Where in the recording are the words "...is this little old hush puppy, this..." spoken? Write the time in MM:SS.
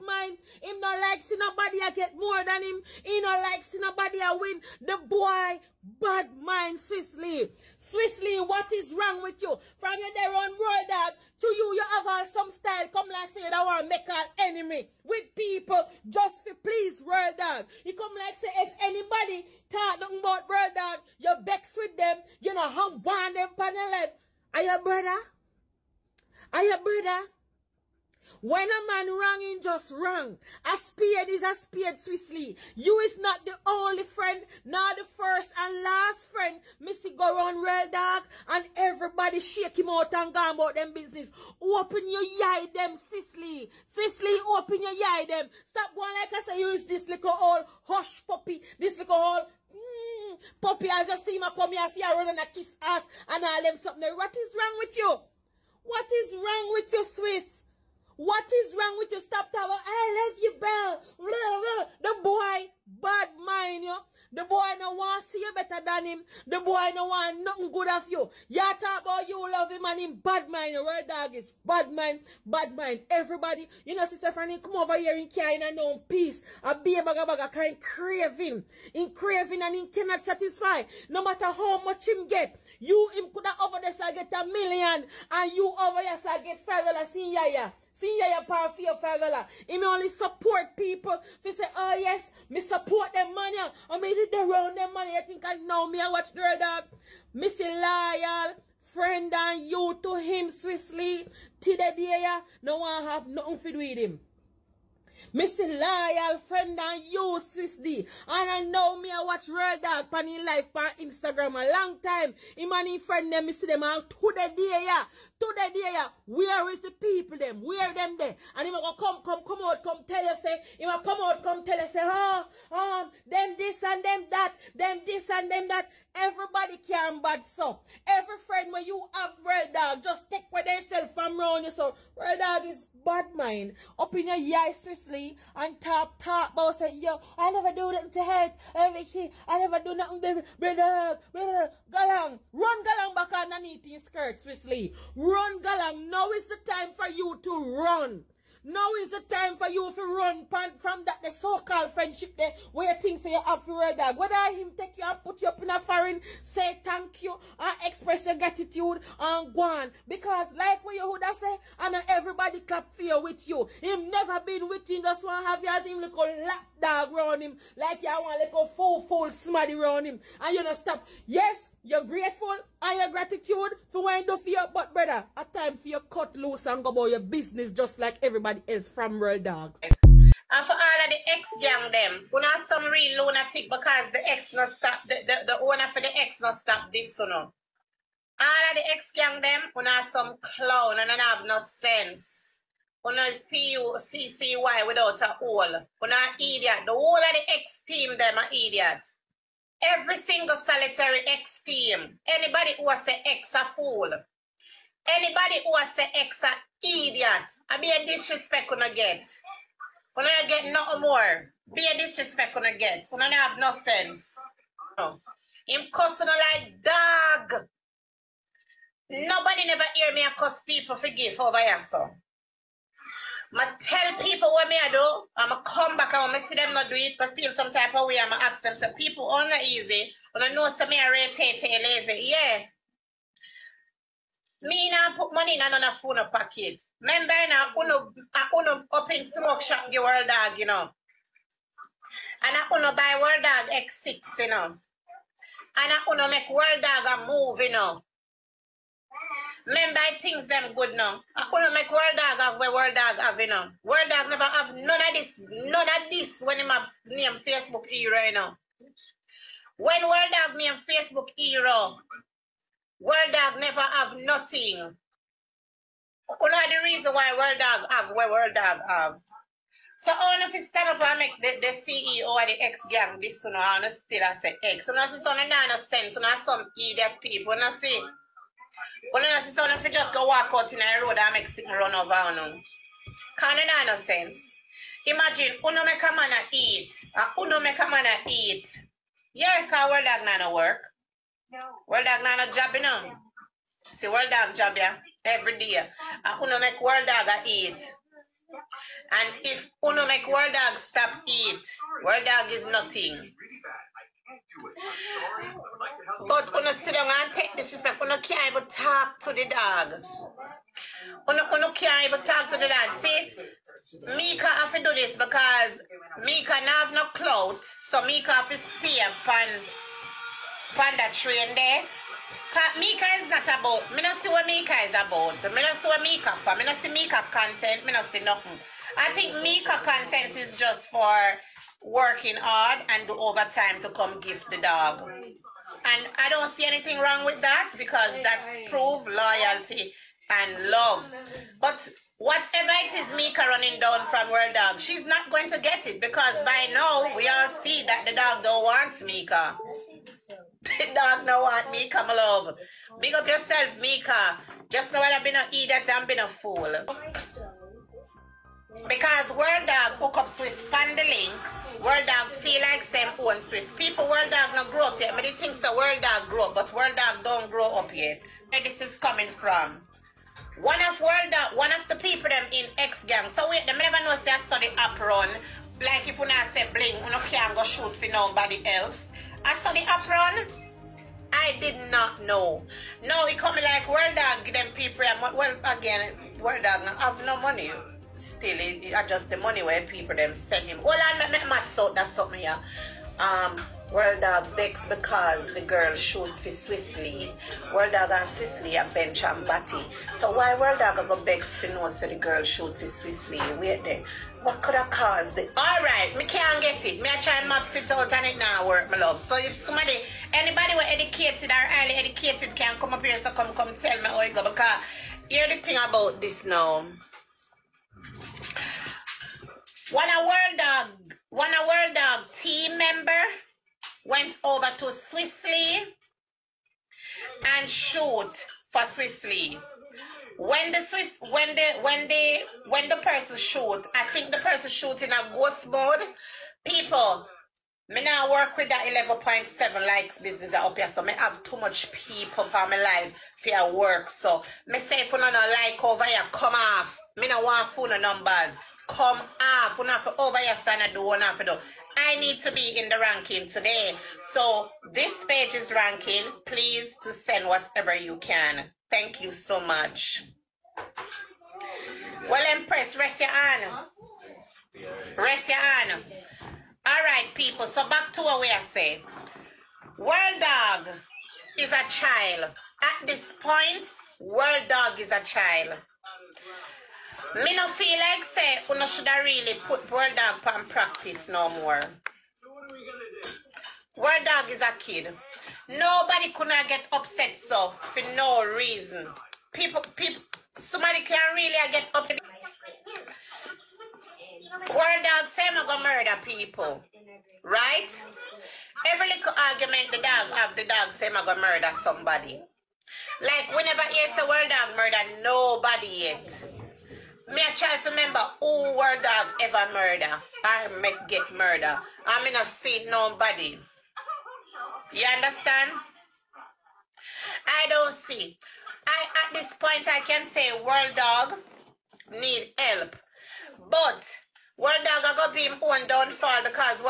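00:46.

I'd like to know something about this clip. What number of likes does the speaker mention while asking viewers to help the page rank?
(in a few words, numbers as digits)
11.7.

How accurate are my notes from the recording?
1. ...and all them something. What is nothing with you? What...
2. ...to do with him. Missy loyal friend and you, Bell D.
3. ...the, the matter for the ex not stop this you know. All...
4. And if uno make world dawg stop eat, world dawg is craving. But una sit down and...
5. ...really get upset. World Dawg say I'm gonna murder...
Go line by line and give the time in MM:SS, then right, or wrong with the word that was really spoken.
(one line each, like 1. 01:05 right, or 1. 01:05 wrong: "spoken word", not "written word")
1. 00:53 wrong: "wrong", not "nothing"
2. 01:43 wrong: "Swiss", not "Bell"
3. 03:05 wrong: "owner", not "matter"
4. 04:59 wrong: "nothing", not "craving"
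5. 08:11 right.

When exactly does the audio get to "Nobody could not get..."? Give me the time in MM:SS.
08:05.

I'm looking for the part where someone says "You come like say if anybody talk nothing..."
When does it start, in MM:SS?
00:17.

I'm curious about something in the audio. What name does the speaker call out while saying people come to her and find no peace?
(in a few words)
Franny.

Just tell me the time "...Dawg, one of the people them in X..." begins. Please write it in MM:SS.
06:11.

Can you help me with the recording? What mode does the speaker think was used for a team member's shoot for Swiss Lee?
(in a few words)
Ghost mode.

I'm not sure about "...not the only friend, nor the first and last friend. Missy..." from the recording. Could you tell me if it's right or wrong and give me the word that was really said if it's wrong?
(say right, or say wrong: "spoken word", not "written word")
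right.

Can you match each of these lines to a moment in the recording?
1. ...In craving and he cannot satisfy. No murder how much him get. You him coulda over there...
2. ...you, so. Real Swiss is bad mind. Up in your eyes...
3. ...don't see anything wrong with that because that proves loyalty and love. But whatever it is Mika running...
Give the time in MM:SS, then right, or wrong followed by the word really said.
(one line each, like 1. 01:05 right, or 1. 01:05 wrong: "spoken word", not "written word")
1. 01:18 wrong: "matter", not "murder"
2. 02:11 wrong: "Dog", not "Swiss"
3. 05:36 right.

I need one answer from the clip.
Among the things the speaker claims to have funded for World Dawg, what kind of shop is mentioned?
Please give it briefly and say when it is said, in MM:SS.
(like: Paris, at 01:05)
Smoke shop, at 03:59.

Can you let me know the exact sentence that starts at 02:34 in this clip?
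Whether him take you and put you up in a foreign, say thank you or express your gratitude and go on.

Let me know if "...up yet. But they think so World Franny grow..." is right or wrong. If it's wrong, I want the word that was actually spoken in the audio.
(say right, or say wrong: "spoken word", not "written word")
wrong: "Dawg", not "Franny".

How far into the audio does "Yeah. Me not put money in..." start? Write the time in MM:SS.
03:52.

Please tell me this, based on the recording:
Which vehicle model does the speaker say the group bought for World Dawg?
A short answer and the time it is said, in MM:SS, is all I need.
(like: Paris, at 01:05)
X6, at 04:03.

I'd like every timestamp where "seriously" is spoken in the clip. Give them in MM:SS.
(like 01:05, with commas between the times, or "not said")
02:24.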